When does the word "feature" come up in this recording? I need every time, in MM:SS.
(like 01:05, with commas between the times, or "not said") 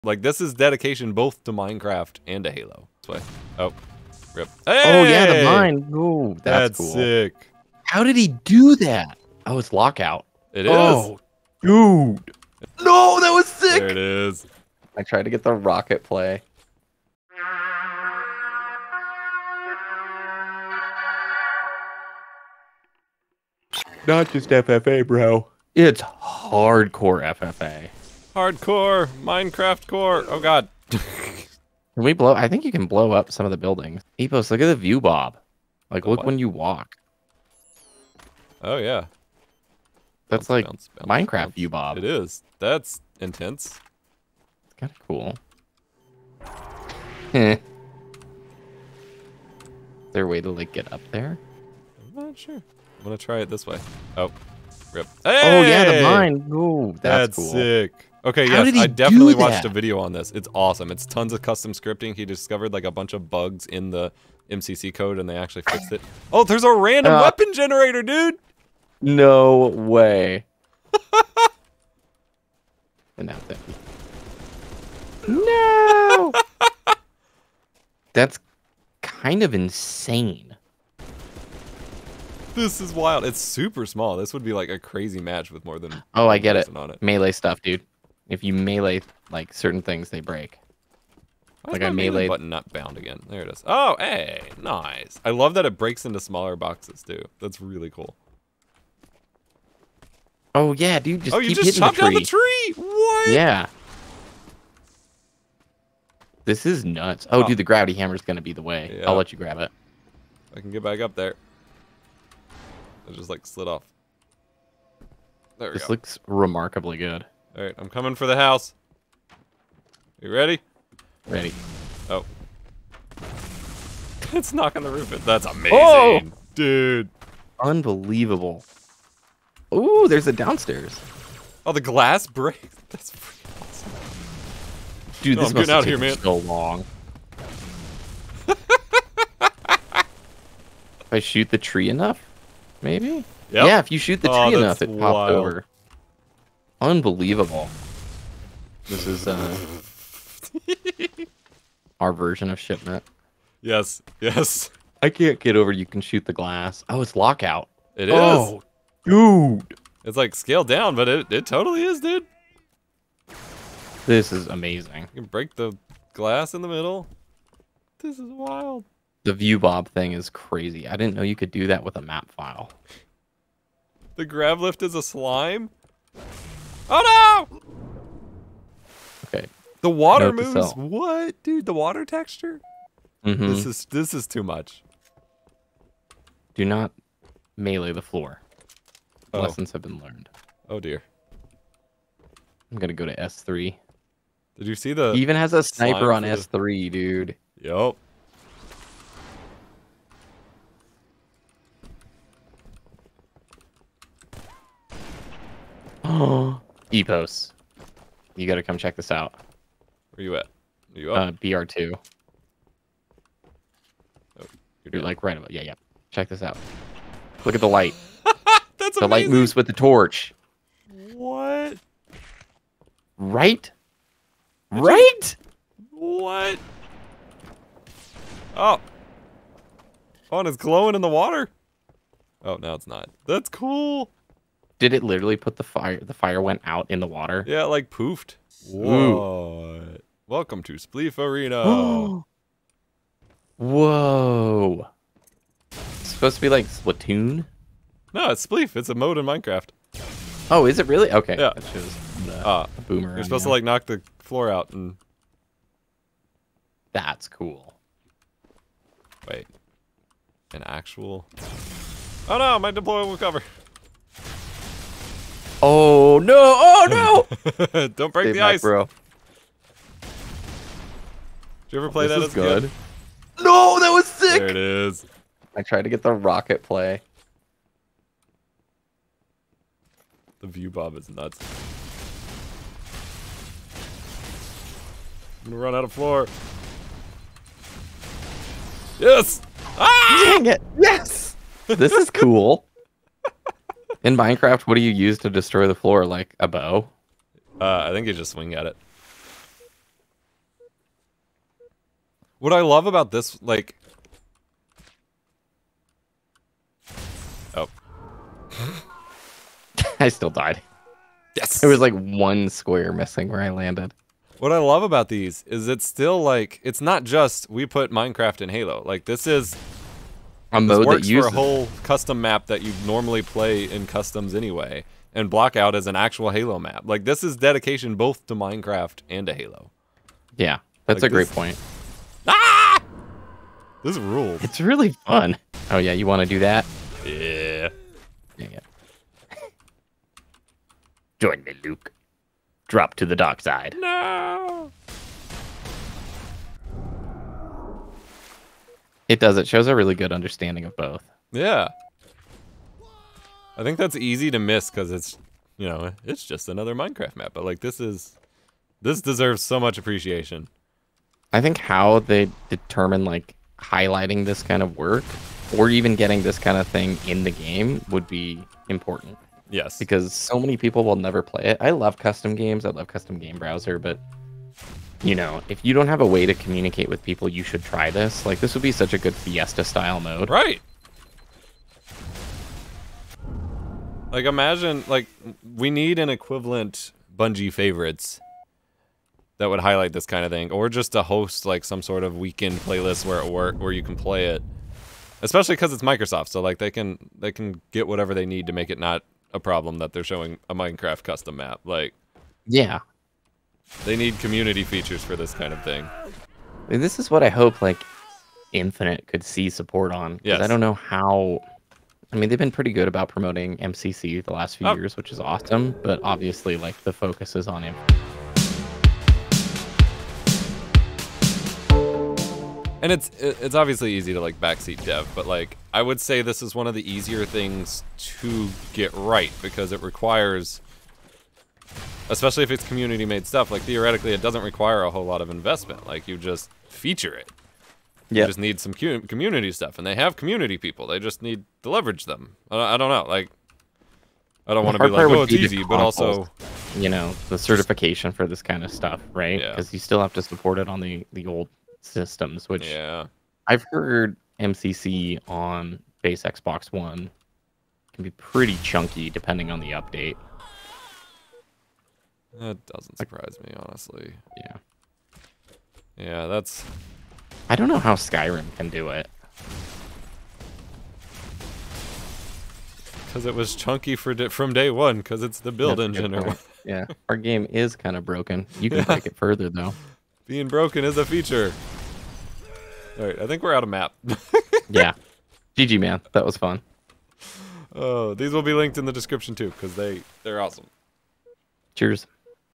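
06:44, 07:16, 08:01.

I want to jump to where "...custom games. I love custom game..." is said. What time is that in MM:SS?
06:11.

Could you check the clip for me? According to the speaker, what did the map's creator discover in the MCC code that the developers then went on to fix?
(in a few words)
a bunch of bugs.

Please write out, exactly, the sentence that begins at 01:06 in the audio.
Oh, there's a random uh, weapon generator, dude.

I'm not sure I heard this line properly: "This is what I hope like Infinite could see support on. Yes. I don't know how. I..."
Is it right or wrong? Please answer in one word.
right.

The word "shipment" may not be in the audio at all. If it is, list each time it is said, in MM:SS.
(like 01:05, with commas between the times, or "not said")
02:32.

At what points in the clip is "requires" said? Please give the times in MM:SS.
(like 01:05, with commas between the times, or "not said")
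07:09, 07:14.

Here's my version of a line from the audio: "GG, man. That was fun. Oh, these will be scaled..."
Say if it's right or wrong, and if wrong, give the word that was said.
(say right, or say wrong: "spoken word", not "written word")
wrong: "linked", not "scaled".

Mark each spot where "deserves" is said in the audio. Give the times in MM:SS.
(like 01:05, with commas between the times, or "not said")
05:59.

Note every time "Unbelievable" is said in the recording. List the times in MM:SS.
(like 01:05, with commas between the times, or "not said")
02:07, 02:26.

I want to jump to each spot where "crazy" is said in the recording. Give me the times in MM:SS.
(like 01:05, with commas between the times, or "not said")
01:24, 02:50.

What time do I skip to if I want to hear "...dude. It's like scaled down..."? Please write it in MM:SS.
02:39.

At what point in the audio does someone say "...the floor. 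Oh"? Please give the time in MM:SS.
03:07.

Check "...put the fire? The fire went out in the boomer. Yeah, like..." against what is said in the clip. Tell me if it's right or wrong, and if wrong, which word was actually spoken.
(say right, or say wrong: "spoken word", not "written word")
wrong: "water", not "boomer".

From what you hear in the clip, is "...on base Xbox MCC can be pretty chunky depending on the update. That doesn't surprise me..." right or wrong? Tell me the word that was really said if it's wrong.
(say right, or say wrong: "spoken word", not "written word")
wrong: "One", not "MCC".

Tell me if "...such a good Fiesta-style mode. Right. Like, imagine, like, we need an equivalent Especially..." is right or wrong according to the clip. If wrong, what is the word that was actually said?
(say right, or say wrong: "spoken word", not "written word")
wrong: "Bungie", not "Especially".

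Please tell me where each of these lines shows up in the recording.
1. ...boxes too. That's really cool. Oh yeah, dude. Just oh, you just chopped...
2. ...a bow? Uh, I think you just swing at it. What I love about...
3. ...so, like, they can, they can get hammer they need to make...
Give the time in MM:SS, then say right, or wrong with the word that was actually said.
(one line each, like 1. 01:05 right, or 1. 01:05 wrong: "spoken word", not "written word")
1. 01:36 right
2. 04:56 right
3. 06:36 wrong: "whatever", not "hammer".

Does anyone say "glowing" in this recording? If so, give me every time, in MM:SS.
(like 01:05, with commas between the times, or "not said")
03:50.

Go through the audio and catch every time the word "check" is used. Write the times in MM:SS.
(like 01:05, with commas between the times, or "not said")
03:28, 03:36.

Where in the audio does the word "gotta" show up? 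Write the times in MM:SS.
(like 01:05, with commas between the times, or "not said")
03:28.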